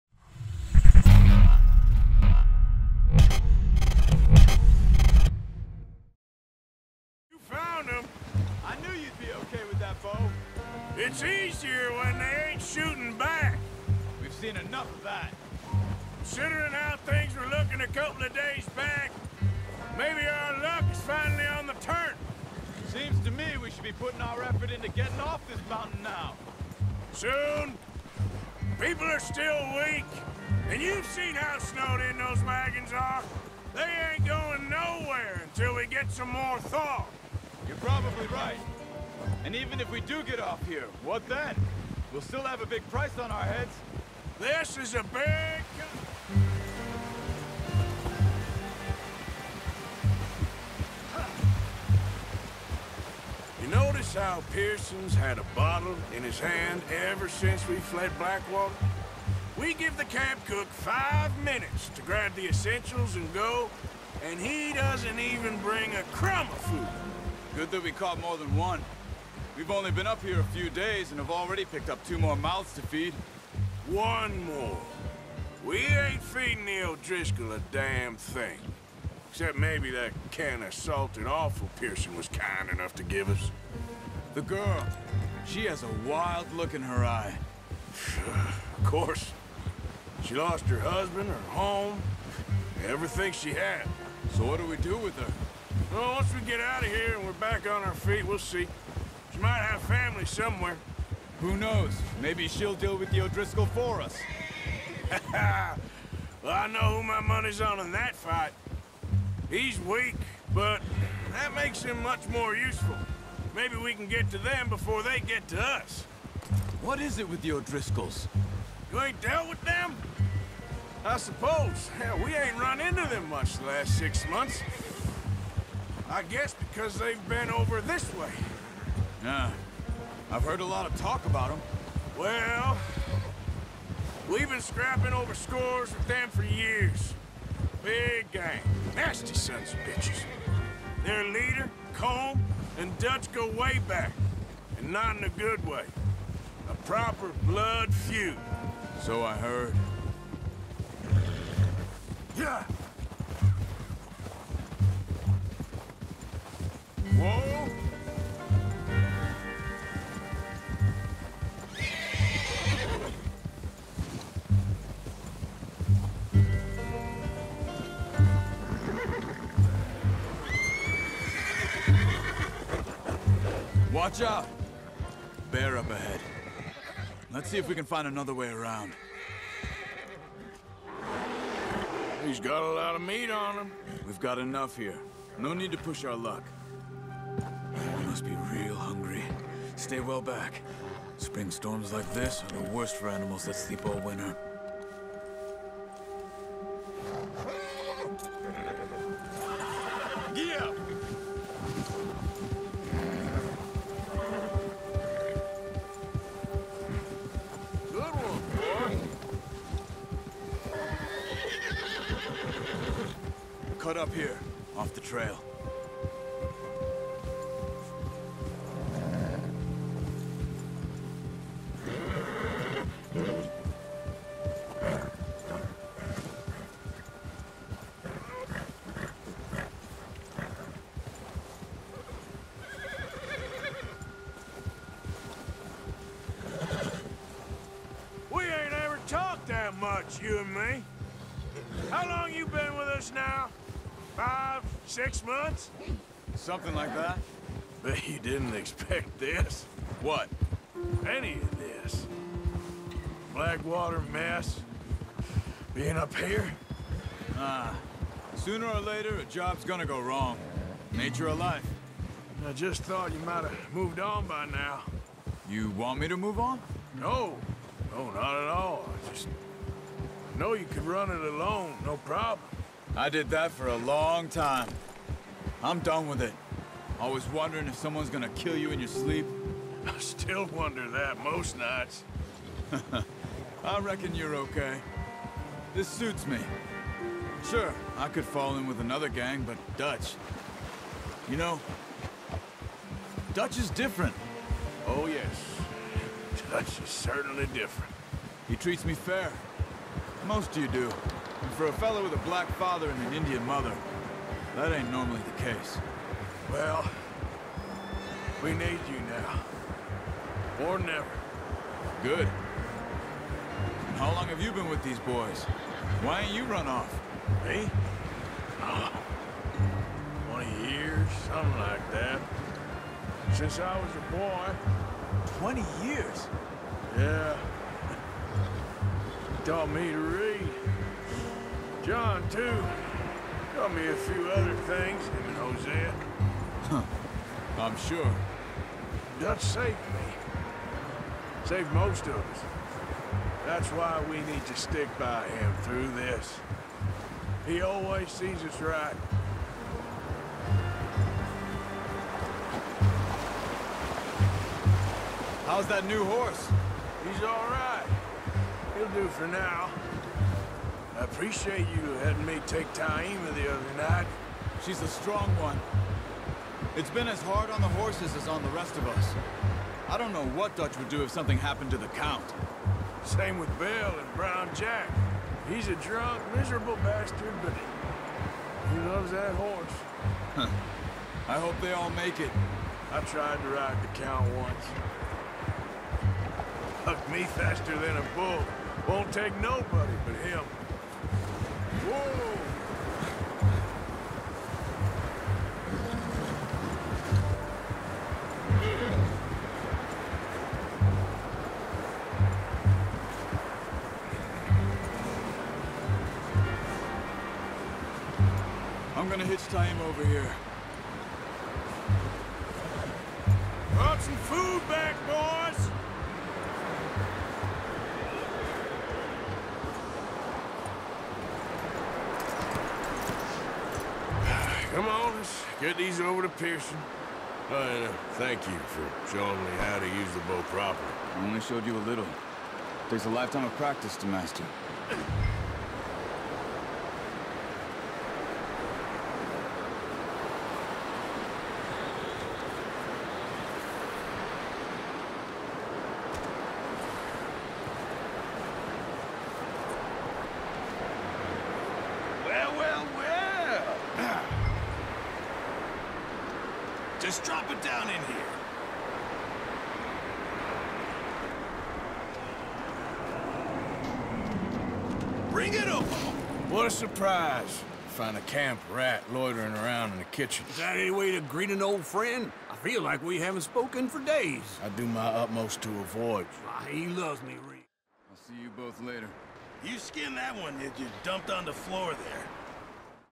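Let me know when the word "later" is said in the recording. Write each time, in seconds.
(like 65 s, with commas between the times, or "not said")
258 s, 478 s.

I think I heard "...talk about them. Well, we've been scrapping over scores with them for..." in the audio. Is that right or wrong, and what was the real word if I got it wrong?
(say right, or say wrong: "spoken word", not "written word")
right.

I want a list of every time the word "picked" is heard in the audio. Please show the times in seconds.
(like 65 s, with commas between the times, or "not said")
71 s.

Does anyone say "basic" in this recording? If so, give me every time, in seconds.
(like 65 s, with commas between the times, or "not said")
not said.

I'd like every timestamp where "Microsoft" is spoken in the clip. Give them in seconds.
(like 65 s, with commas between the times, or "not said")
not said.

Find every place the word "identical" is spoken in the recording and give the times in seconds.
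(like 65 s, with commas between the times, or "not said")
not said.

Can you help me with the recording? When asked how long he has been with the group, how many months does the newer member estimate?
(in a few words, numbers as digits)
5 or 6 months.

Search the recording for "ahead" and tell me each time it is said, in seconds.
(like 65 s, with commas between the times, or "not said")
175 s.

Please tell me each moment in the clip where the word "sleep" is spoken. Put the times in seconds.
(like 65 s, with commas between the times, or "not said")
193 s, 278 s.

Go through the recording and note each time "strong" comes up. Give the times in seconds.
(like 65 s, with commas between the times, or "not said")
364 s.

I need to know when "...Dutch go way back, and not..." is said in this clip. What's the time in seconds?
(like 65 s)
142 s.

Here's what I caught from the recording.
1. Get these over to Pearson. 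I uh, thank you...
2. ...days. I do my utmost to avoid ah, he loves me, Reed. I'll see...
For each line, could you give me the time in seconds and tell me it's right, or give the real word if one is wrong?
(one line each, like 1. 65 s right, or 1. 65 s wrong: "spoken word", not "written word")
1. 425 s right
2. 474 s right.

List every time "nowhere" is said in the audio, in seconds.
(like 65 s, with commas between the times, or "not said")
34 s.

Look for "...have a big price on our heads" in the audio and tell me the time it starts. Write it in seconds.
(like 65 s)
42 s.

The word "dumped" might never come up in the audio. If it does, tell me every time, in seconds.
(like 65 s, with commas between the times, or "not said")
481 s.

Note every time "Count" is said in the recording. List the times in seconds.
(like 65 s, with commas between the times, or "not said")
371 s, 383 s.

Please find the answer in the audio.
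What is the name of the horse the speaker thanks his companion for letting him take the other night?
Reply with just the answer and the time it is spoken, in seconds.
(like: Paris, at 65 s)
Taima, at 362 s.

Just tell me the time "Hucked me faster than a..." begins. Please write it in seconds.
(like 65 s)
386 s.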